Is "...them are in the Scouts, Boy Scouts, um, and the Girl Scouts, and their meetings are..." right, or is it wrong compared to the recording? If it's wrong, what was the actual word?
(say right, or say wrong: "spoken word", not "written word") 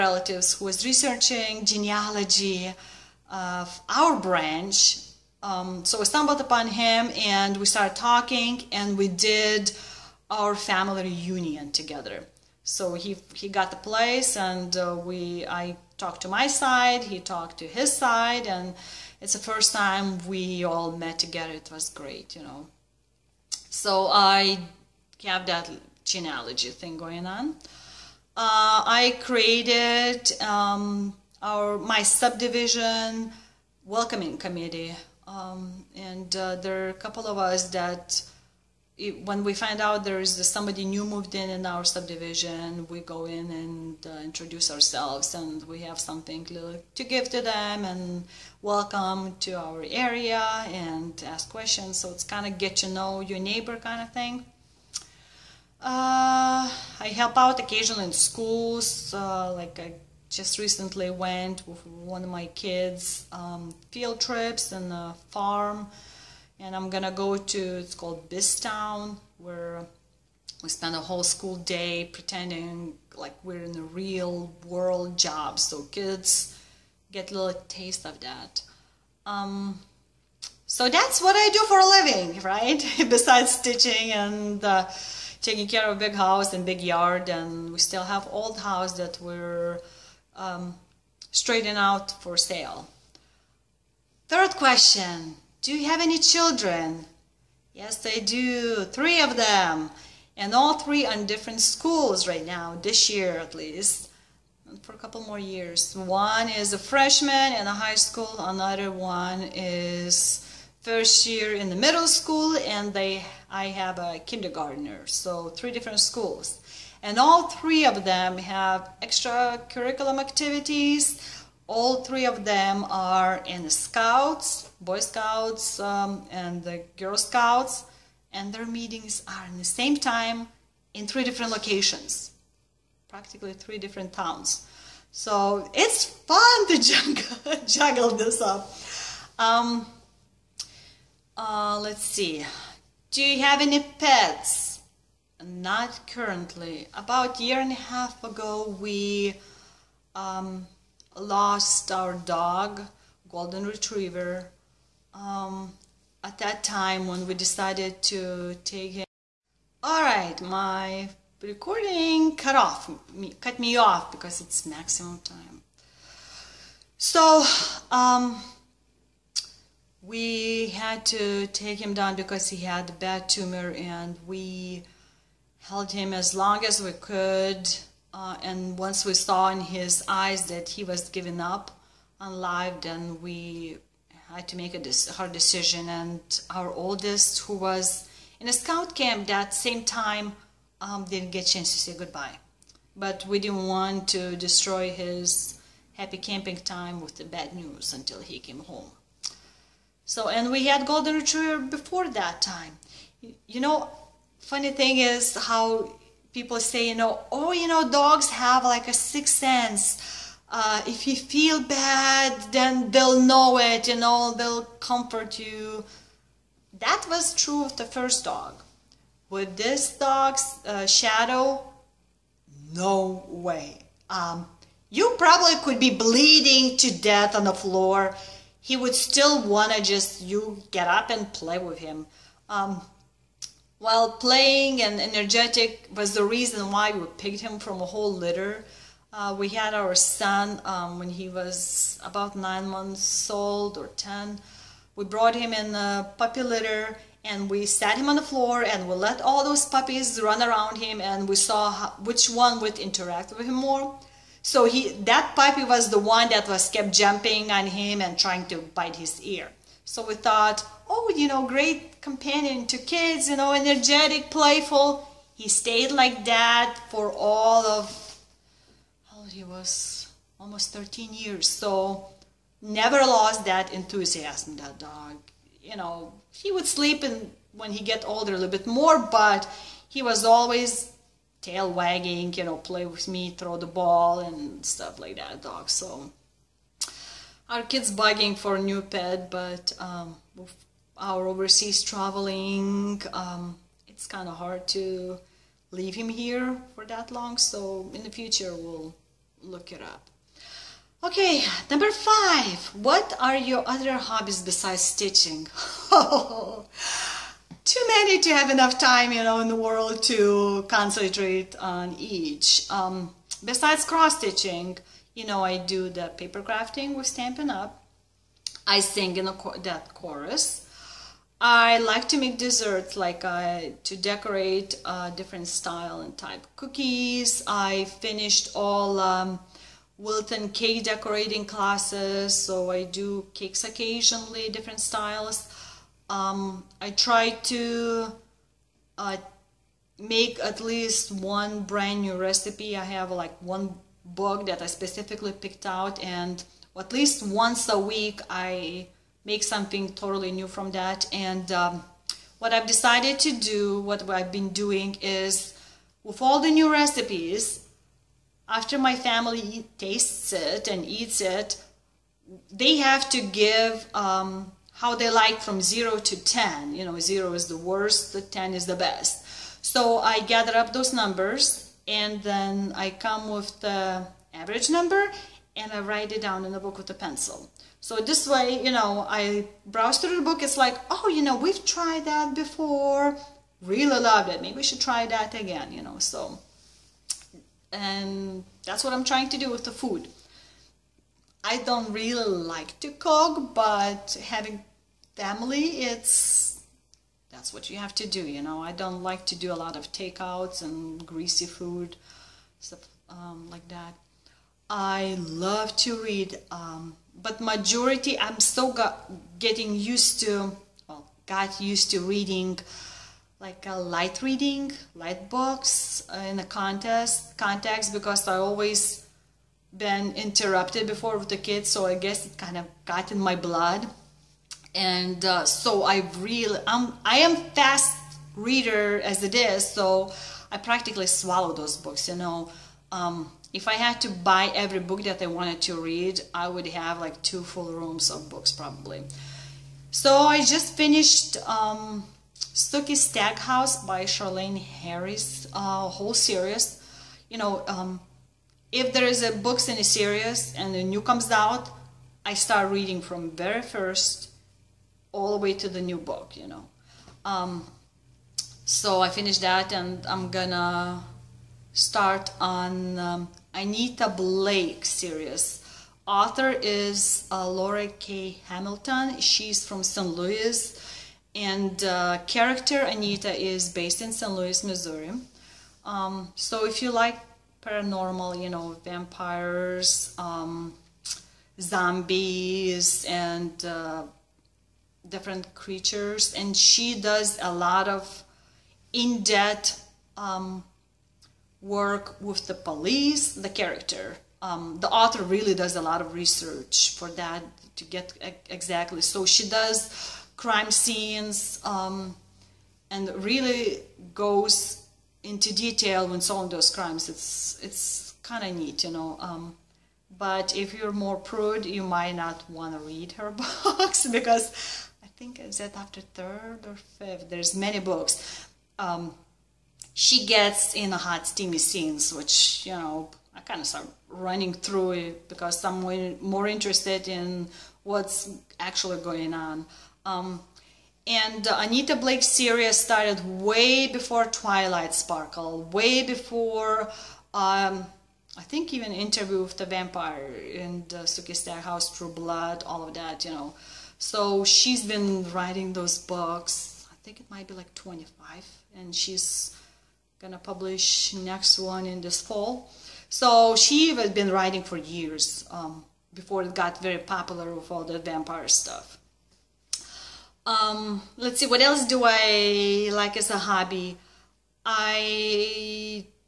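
right.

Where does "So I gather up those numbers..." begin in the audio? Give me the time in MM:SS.
06:09.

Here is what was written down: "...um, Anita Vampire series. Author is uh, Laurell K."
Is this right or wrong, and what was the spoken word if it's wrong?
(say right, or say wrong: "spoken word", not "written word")
wrong: "Blake", not "Vampire".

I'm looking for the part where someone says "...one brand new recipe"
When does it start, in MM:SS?
05:41.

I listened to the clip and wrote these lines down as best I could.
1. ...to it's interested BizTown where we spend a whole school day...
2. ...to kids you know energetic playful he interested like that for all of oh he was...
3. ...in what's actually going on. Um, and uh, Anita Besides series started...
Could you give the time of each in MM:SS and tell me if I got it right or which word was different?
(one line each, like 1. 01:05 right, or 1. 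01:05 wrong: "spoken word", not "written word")
1. 01:07 wrong: "called", not "interested"
2. 04:22 wrong: "stayed", not "interested"
3. 08:47 wrong: "Blake", not "Besides".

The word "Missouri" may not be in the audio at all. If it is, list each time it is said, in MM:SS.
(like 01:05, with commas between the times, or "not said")
07:54.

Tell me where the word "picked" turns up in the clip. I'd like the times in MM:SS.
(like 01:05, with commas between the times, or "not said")
03:57, 05:45.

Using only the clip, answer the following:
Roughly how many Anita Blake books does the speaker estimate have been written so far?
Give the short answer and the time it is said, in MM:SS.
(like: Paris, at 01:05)
25, at 09:07.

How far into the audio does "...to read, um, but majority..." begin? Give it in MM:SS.
06:45.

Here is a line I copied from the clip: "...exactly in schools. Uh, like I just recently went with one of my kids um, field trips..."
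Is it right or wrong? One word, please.
wrong.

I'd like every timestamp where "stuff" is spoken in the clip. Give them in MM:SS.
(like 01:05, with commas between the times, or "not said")
04:44, 06:42, 09:18.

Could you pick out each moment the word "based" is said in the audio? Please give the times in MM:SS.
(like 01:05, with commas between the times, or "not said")
07:53.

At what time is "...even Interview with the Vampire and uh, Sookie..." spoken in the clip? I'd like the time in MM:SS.
08:58.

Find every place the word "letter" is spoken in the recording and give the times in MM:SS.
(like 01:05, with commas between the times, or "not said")
not said.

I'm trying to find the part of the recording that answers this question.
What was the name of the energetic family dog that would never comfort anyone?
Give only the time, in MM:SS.
03:40.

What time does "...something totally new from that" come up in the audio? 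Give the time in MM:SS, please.
05:49.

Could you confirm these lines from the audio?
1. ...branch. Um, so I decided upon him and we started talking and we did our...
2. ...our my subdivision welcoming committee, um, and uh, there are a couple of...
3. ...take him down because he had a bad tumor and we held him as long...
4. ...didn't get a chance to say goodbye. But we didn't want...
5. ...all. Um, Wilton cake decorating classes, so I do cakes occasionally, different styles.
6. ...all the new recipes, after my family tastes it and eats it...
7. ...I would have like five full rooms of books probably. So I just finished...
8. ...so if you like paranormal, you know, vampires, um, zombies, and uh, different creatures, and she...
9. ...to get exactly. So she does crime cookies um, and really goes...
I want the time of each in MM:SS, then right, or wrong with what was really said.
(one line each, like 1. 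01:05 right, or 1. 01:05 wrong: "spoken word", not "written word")
1. 00:04 wrong: "stumbled", not "decided"
2. 00:31 right
3. 02:51 right
4. 03:11 right
5. 05:28 right
6. 05:56 right
7. 07:16 wrong: "two", not "five"
8. 07:56 right
9. 08:17 wrong: "scenes", not "cookies".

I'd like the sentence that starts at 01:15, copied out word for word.
So kids get a little taste of that.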